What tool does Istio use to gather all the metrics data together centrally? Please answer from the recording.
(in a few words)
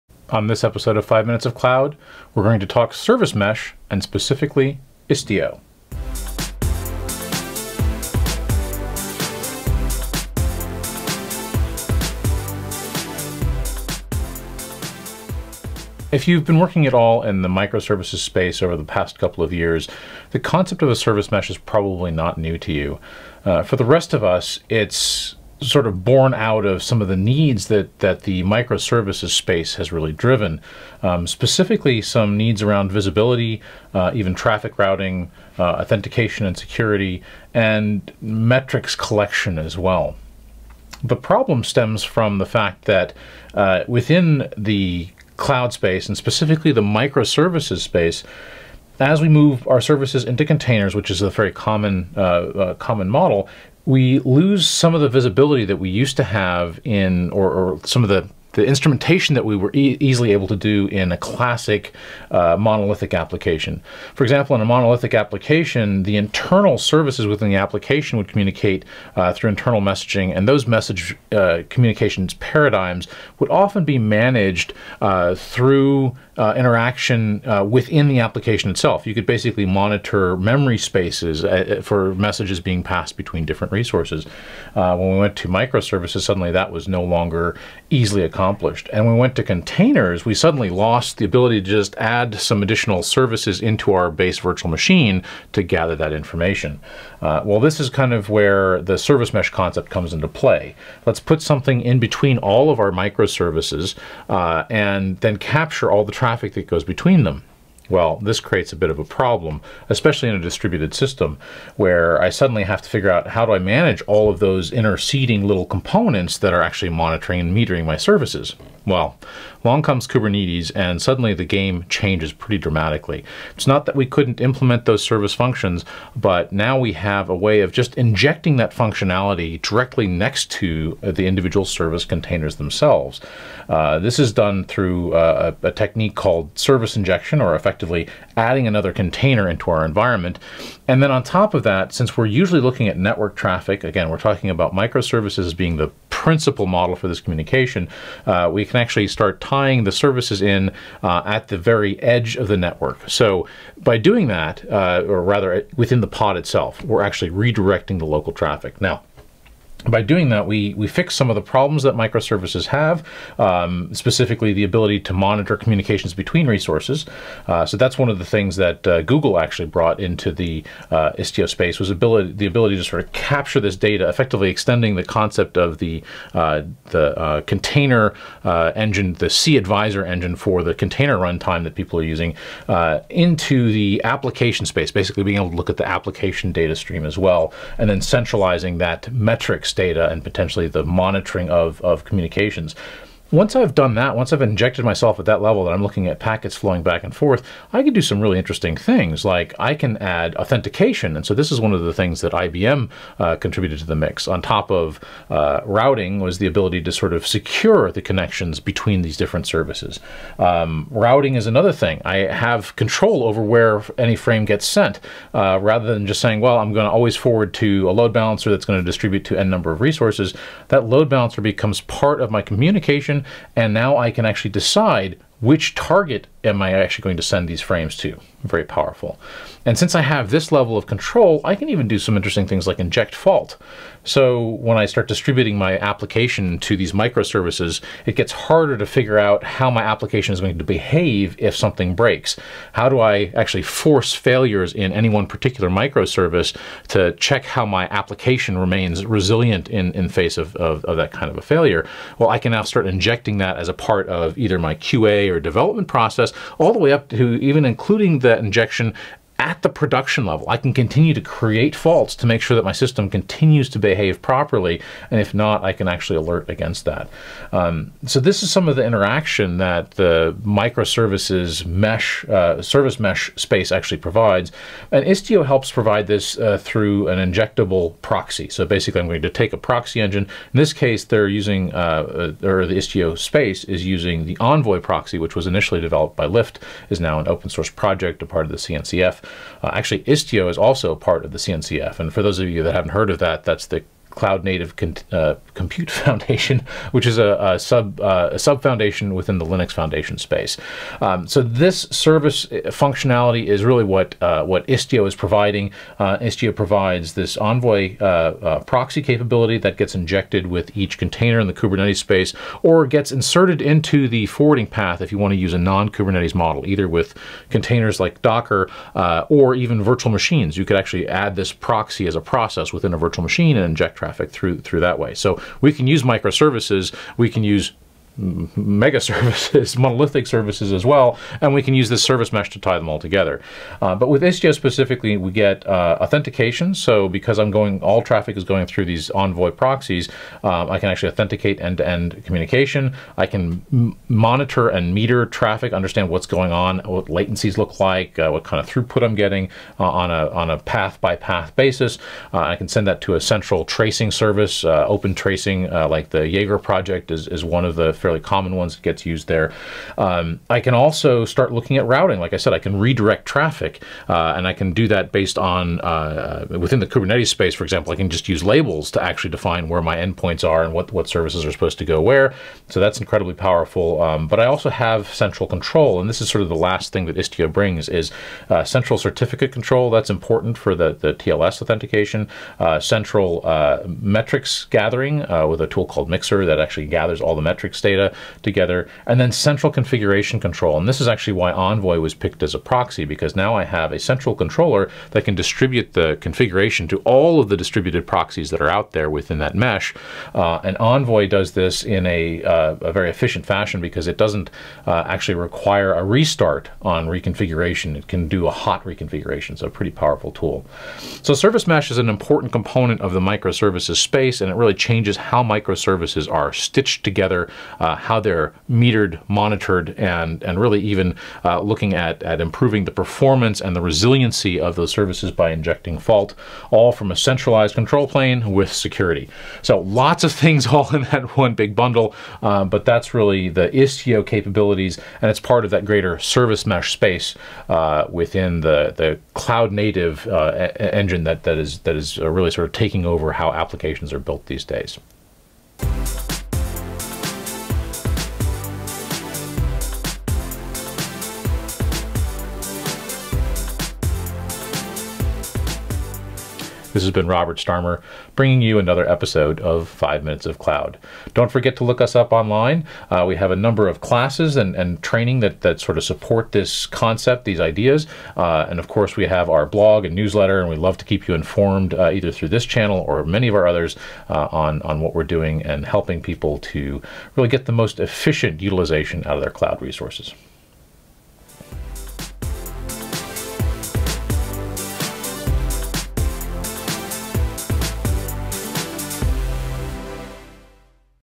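Mixer.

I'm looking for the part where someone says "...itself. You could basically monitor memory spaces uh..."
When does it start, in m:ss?
1:18.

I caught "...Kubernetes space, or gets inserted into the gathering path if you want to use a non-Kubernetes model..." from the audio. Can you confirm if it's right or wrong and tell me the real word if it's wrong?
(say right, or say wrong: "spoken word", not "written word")
wrong: "forwarding", not "gathering".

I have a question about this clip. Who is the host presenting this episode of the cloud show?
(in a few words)
Robert Starmer.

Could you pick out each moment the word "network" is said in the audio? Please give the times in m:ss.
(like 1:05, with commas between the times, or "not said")
2:22, 2:32.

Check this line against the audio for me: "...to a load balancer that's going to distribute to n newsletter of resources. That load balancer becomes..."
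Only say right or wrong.
wrong.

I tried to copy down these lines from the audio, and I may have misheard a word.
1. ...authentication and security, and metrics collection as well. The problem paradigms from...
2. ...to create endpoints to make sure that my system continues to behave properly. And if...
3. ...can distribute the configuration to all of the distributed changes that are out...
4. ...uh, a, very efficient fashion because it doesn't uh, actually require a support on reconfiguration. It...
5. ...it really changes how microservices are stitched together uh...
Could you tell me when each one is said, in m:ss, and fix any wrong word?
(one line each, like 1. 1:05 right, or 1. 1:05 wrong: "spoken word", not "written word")
1. 0:35 wrong: "stems", not "paradigms"
2. 4:21 wrong: "faults", not "endpoints"
3. 6:35 wrong: "proxies", not "changes"
4. 6:42 wrong: "restart", not "support"
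5. 6:54 right.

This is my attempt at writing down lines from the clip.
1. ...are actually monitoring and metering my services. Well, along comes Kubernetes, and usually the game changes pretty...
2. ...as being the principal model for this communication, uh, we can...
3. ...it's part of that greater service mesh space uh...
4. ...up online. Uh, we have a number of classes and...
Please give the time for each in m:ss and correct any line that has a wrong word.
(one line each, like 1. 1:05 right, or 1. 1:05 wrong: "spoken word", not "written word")
1. 1:56 wrong: "suddenly", not "usually"
2. 2:25 right
3. 7:15 right
4. 7:42 right.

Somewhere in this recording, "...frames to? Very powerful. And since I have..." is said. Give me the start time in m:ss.
3:47.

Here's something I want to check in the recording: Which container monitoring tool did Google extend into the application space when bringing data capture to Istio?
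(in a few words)
cAdvisor.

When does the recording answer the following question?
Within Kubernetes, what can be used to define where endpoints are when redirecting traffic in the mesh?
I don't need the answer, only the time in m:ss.
6:08.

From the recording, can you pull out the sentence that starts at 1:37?
Uh, well, this is kind of where the service mesh concept comes into play.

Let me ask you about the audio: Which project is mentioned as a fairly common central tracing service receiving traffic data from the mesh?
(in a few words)
Jaeger.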